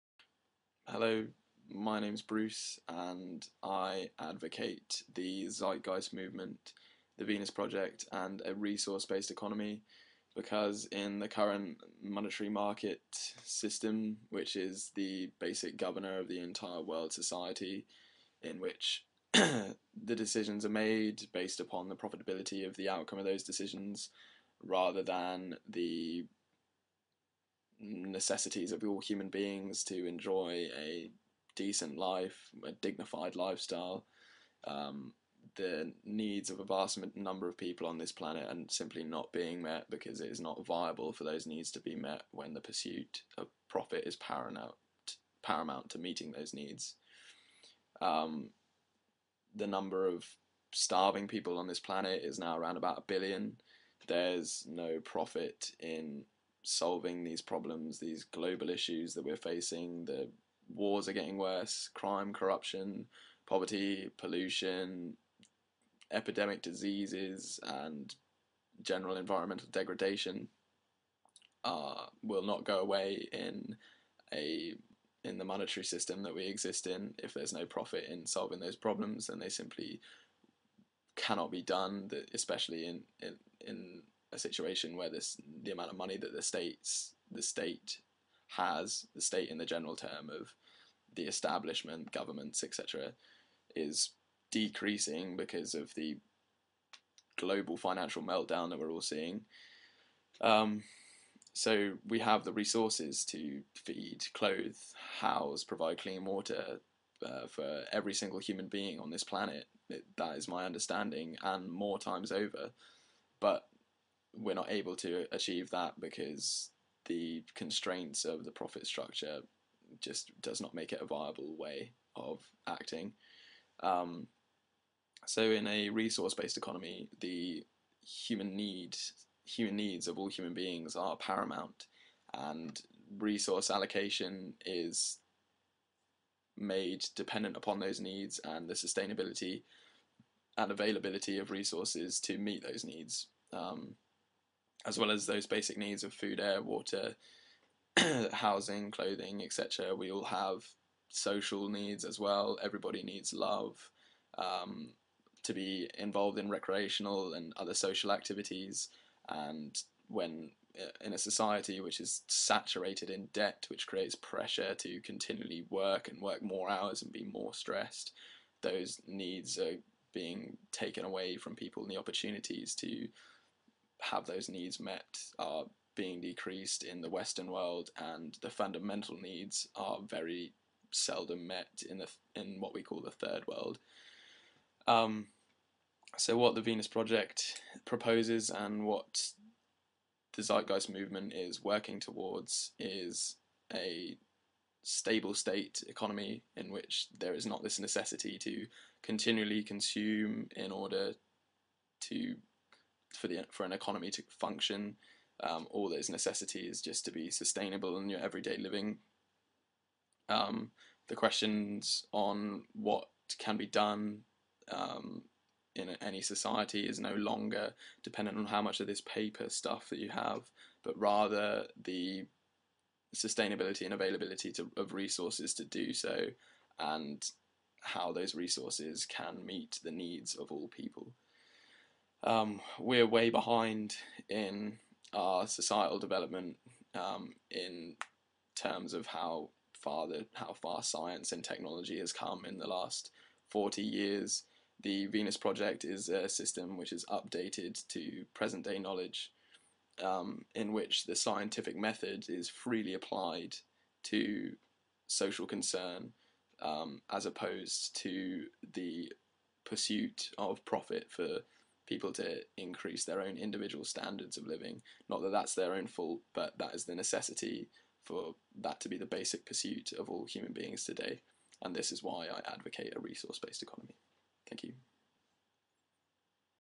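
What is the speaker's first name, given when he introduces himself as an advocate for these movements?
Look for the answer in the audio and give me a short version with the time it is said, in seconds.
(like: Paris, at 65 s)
Bruce, at 2 s.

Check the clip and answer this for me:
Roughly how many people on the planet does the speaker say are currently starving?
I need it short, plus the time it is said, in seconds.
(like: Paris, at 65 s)
around 1 billion, at 52 s.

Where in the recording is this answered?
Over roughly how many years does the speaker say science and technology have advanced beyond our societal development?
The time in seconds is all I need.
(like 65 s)
243 s.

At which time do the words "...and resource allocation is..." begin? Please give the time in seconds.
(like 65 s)
132 s.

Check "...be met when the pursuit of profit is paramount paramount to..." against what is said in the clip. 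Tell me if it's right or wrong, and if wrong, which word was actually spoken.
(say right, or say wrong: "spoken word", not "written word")
right.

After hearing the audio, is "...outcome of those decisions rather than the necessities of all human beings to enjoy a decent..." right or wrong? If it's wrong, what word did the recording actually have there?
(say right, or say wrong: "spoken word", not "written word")
right.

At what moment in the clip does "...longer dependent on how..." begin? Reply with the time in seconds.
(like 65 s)
217 s.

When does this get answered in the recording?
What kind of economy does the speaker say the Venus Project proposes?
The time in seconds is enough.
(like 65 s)
194 s.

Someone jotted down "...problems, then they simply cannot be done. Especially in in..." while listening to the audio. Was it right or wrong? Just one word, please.
right.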